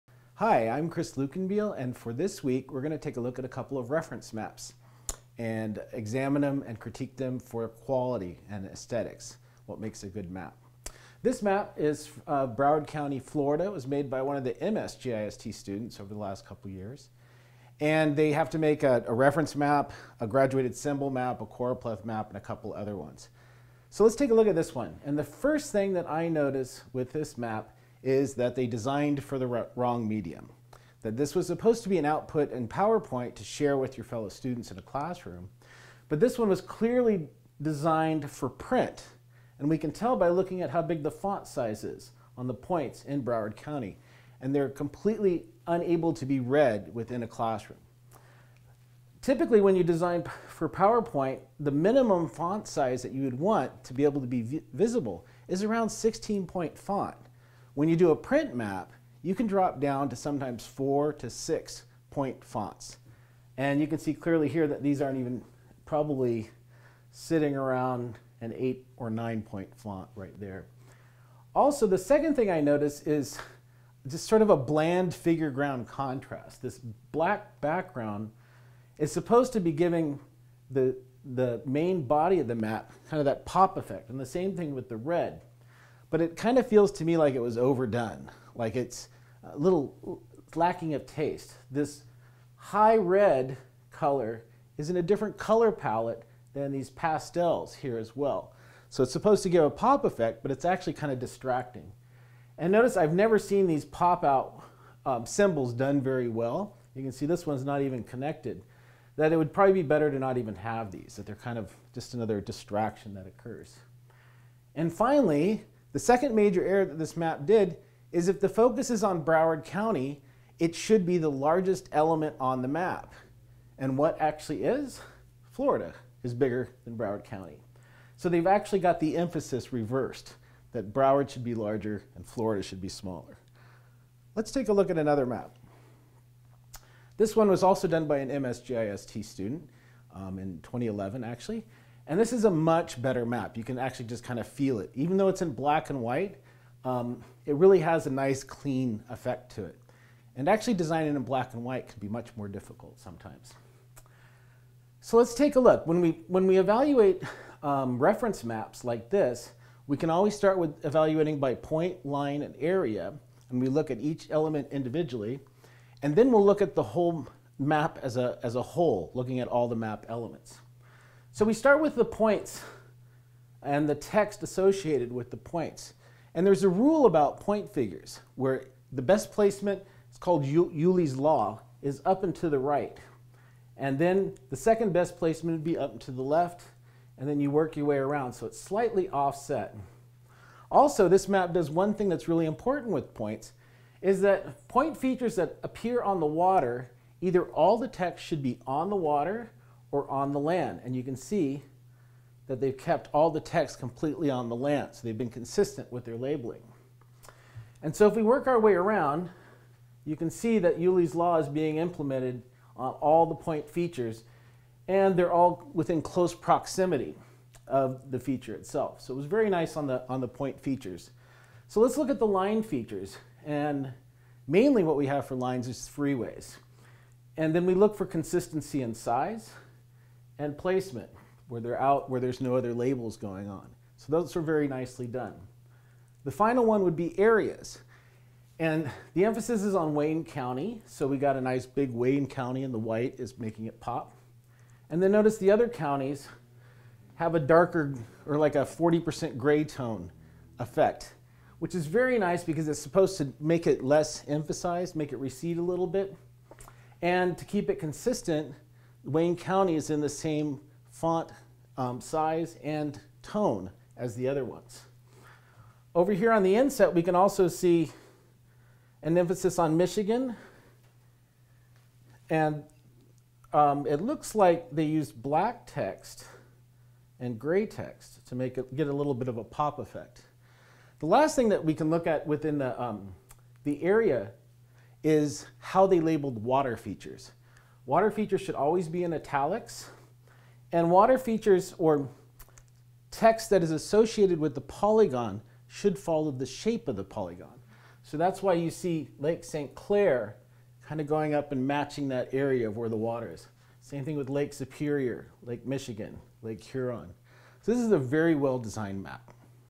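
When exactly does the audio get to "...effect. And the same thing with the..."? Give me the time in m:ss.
1:23.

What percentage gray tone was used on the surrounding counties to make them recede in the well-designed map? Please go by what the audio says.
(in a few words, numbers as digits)
40%.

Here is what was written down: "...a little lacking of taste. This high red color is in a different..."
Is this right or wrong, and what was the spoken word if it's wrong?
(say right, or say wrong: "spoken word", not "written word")
right.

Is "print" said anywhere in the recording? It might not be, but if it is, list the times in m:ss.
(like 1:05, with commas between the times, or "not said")
0:38, 0:58.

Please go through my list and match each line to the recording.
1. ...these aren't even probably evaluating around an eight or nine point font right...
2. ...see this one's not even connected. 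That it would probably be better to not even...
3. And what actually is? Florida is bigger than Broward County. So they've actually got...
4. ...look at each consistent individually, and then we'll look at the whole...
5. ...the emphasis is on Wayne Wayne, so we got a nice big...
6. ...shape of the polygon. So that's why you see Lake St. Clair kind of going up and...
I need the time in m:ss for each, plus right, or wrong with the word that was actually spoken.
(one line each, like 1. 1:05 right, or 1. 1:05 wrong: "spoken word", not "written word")
1. 1:04 wrong: "sitting", not "evaluating"
2. 1:47 right
3. 2:03 right
4. 2:43 wrong: "element", not "consistent"
5. 3:59 wrong: "County", not "Wayne"
6. 4:56 right.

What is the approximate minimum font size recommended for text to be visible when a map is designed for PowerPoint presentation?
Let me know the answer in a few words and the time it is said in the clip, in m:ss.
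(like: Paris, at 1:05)
16 point, at 0:55.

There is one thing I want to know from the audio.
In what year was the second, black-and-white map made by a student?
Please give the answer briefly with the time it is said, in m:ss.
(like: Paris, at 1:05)
2011, at 2:20.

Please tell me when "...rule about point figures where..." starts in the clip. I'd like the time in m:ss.
2:56.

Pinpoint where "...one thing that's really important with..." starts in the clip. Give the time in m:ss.
3:11.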